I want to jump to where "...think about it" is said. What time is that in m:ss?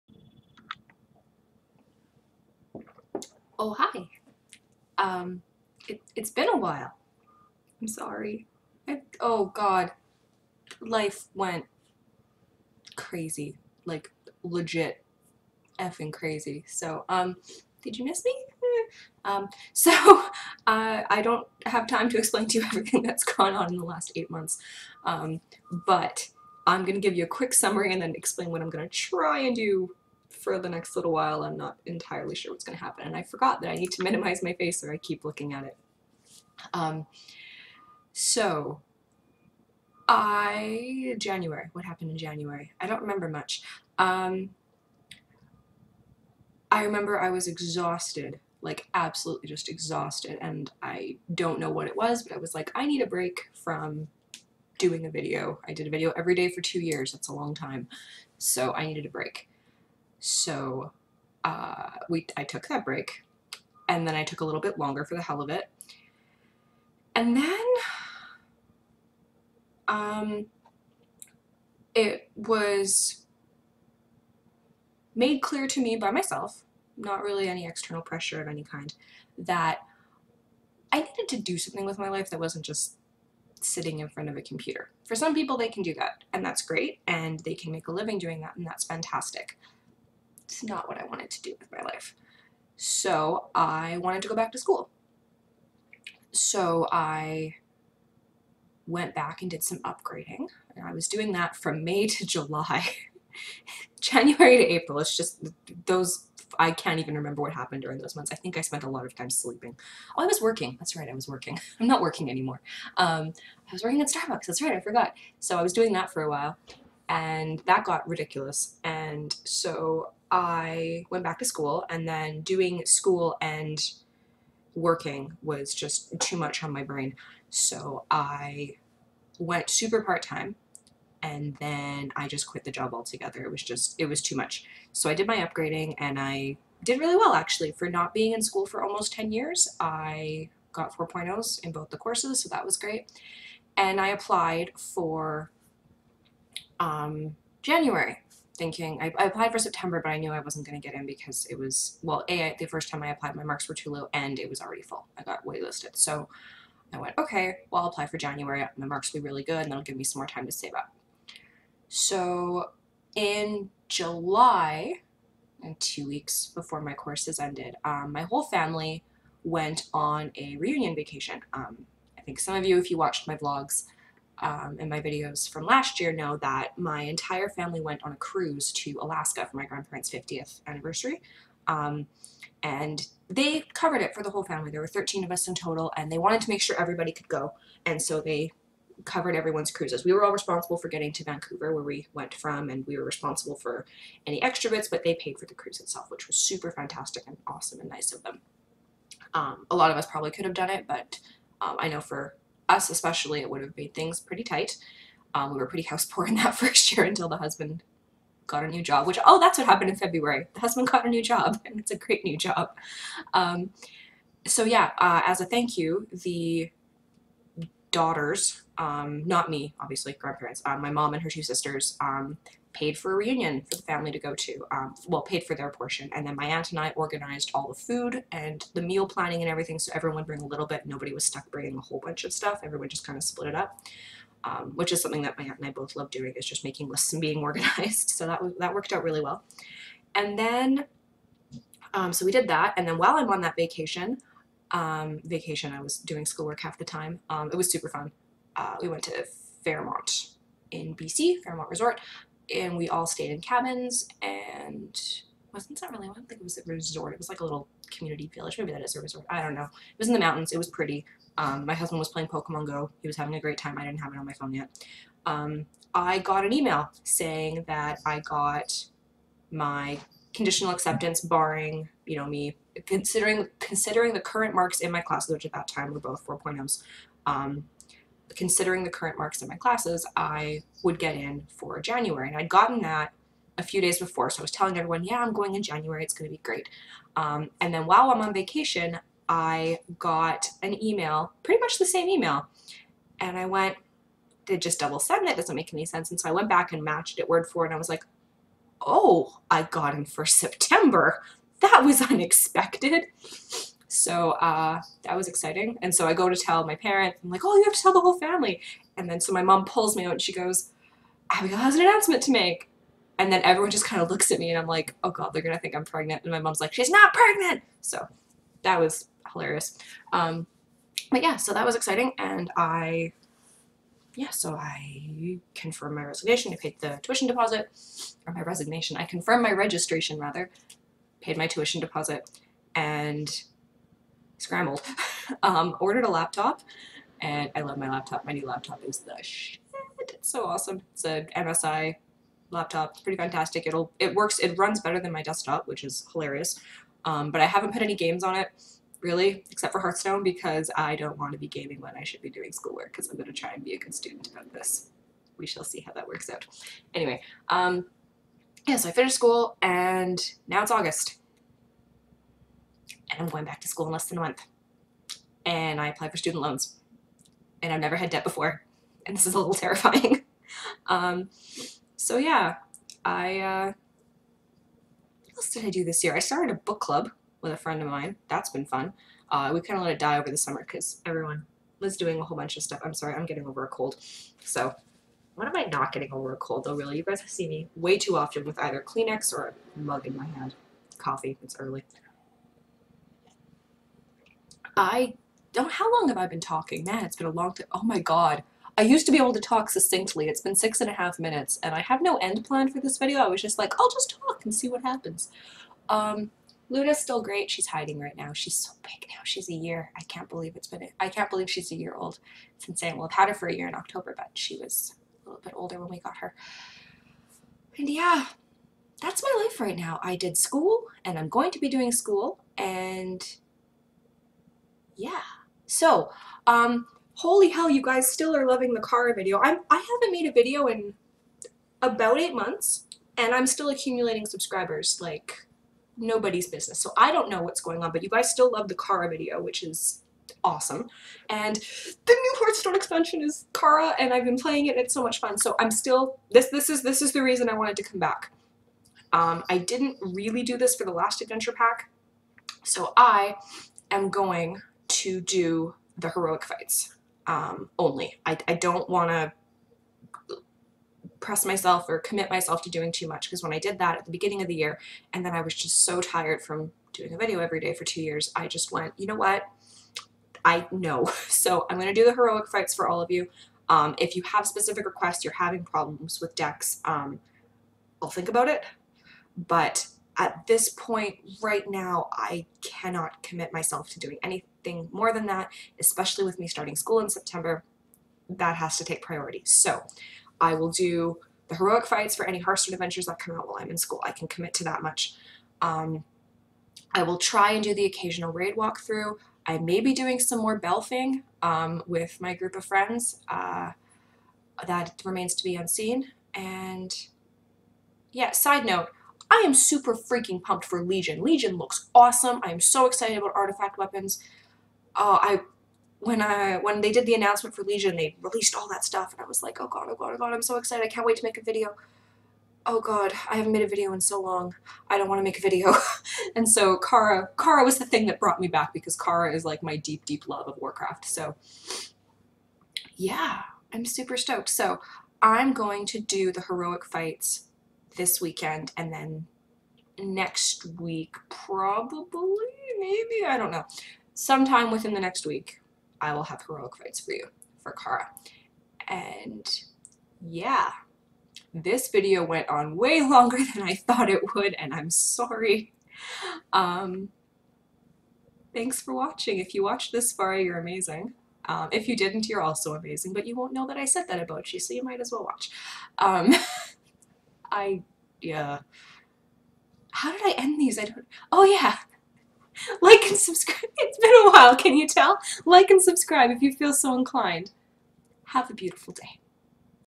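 7:58.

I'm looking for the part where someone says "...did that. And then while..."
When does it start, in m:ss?
4:02.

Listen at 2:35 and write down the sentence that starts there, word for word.
I got waitlisted, so I went okay.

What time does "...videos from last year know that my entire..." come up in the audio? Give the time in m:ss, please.
2:55.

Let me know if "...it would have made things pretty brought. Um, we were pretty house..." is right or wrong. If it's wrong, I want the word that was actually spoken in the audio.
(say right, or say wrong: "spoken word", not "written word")
wrong: "tight", not "brought".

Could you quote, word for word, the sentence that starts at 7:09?
I'm, I haven't made a video in about eight months, and I'm still accumulating subscribers like nobody's business.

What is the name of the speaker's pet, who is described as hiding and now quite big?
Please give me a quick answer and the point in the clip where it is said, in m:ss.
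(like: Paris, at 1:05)
Luna, at 6:46.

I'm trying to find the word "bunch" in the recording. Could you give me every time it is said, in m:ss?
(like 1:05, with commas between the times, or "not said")
3:52, 6:22.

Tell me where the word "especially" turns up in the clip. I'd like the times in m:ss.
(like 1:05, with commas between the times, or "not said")
3:22, 8:05.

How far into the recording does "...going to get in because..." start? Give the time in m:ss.
2:30.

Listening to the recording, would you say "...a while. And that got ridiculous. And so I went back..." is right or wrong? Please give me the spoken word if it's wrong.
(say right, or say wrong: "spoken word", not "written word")
right.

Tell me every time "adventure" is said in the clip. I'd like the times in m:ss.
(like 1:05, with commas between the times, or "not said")
7:31, 8:12.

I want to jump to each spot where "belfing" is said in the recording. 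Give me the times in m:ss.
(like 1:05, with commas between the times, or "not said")
8:20.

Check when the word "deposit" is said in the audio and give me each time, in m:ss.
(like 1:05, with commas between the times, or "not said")
5:27, 5:31.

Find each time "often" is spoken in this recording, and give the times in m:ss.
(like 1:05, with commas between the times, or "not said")
6:28.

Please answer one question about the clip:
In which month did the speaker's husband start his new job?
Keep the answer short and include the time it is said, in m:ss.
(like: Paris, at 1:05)
February, at 3:29.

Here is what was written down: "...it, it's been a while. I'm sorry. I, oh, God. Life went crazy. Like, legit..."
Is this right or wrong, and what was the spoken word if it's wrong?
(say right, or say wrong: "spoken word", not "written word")
right.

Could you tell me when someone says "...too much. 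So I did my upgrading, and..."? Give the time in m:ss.
2:14.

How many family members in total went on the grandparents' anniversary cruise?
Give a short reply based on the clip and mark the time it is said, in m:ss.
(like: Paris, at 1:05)
13, at 3:04.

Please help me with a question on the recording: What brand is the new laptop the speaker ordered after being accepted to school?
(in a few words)
MSI.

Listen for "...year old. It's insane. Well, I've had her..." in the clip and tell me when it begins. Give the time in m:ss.
6:51.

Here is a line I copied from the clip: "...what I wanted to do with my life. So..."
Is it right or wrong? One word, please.
right.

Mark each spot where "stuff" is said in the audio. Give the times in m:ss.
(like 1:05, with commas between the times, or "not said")
3:52, 6:22, 8:38.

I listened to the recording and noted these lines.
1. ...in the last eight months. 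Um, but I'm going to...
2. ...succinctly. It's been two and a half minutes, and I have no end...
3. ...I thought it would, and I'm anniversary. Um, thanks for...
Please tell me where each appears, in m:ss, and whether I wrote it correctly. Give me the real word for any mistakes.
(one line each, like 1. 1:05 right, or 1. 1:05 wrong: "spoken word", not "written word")
1. 0:23 right
2. 6:39 wrong: "six", not "two"
3. 9:13 wrong: "sorry", not "anniversary".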